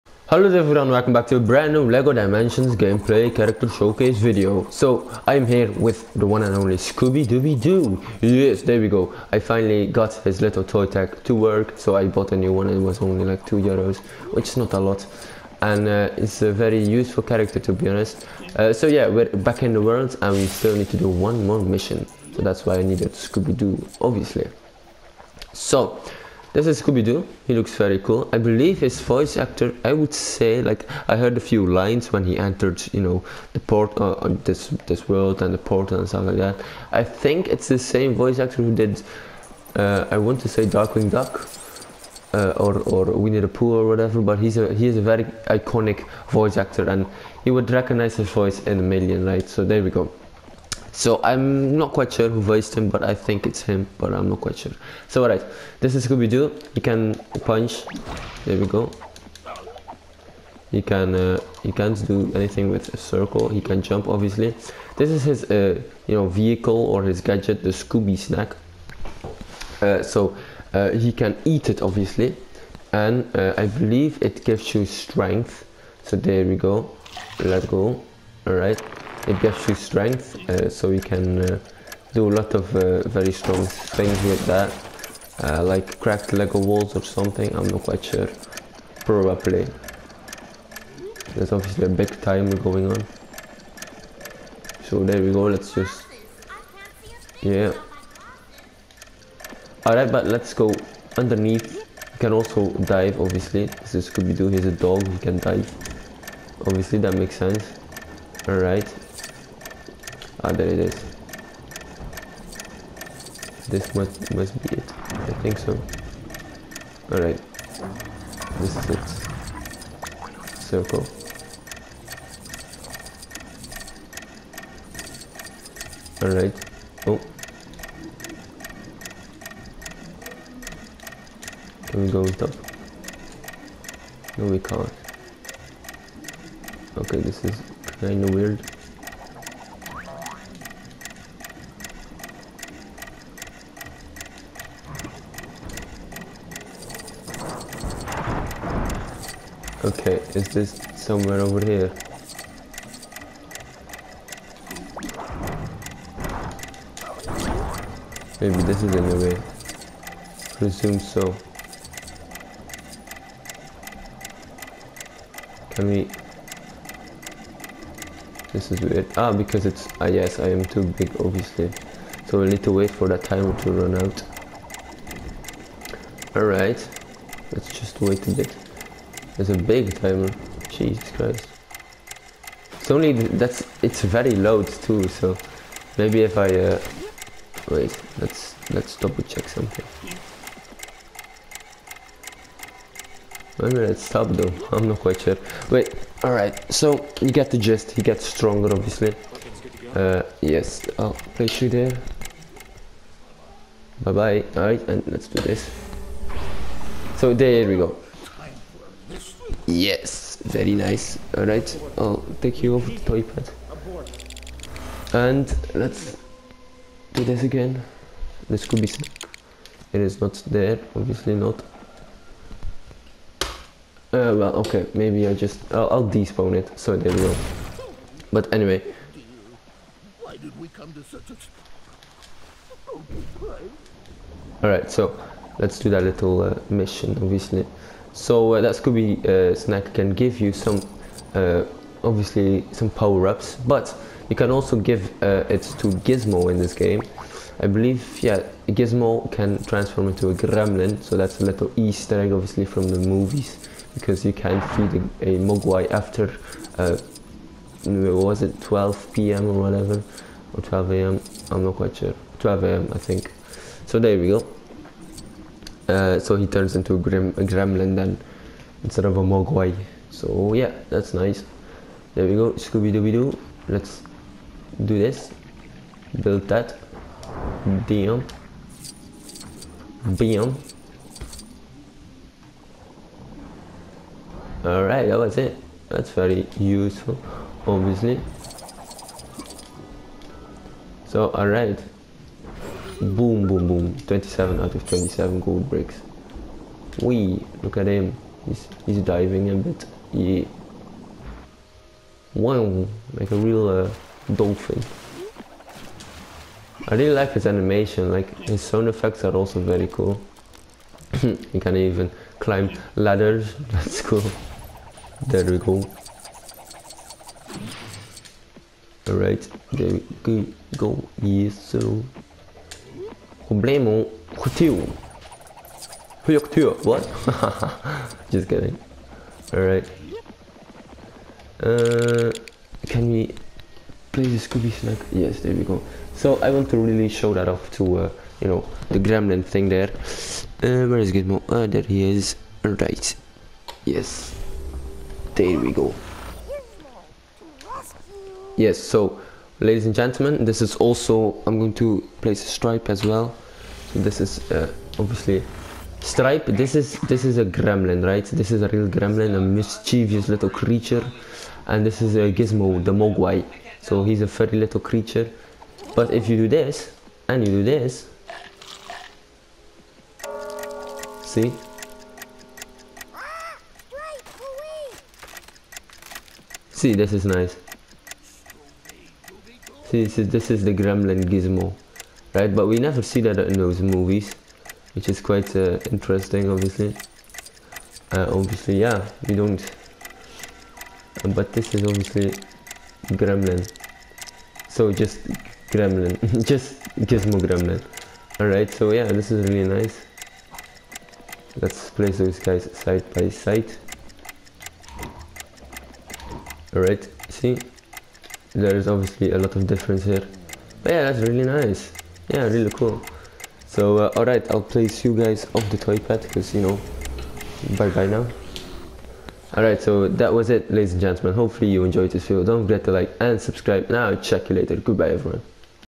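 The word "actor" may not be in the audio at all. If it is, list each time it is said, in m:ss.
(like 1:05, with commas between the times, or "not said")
0:29, 0:38, 0:46.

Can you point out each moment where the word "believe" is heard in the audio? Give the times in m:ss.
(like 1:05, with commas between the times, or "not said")
0:28, 1:13, 4:07.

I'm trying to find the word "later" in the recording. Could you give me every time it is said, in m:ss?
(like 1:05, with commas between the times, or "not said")
7:04.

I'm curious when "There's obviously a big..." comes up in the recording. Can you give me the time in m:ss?
1:31.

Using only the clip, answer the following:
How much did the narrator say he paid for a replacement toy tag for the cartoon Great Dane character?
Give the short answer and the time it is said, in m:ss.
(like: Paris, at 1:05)
2 euros, at 0:13.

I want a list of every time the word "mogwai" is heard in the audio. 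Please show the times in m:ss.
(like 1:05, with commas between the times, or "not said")
4:15, 4:29, 6:02.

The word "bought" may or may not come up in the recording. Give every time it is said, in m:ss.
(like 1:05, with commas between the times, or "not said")
0:12.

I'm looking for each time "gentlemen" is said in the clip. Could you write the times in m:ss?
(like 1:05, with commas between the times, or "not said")
5:49, 7:01.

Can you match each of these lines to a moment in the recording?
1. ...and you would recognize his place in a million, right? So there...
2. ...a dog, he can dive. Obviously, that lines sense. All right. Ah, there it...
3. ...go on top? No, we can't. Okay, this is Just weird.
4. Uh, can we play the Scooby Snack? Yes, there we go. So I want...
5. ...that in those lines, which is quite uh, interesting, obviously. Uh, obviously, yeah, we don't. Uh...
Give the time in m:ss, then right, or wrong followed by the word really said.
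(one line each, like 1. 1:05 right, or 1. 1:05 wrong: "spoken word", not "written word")
1. 0:46 wrong: "voice", not "place"
2. 1:44 wrong: "makes", not "lines"
3. 2:12 wrong: "Kinda", not "Just"
4. 5:31 right
5. 6:23 wrong: "movies", not "lines".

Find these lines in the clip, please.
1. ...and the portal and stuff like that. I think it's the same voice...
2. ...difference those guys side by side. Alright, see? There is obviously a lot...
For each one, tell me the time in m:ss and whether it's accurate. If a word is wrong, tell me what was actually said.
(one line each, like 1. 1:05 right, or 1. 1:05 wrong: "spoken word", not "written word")
1. 0:35 right
2. 6:41 wrong: "place", not "difference".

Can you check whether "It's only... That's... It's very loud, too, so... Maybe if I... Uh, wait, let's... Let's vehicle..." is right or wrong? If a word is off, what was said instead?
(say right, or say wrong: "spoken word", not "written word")
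wrong: "double", not "vehicle".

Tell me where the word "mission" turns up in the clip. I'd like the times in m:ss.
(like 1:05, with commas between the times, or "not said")
0:21, 3:56.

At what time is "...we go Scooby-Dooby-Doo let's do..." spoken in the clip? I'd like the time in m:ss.
4:32.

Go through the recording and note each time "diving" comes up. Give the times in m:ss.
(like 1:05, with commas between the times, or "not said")
4:58.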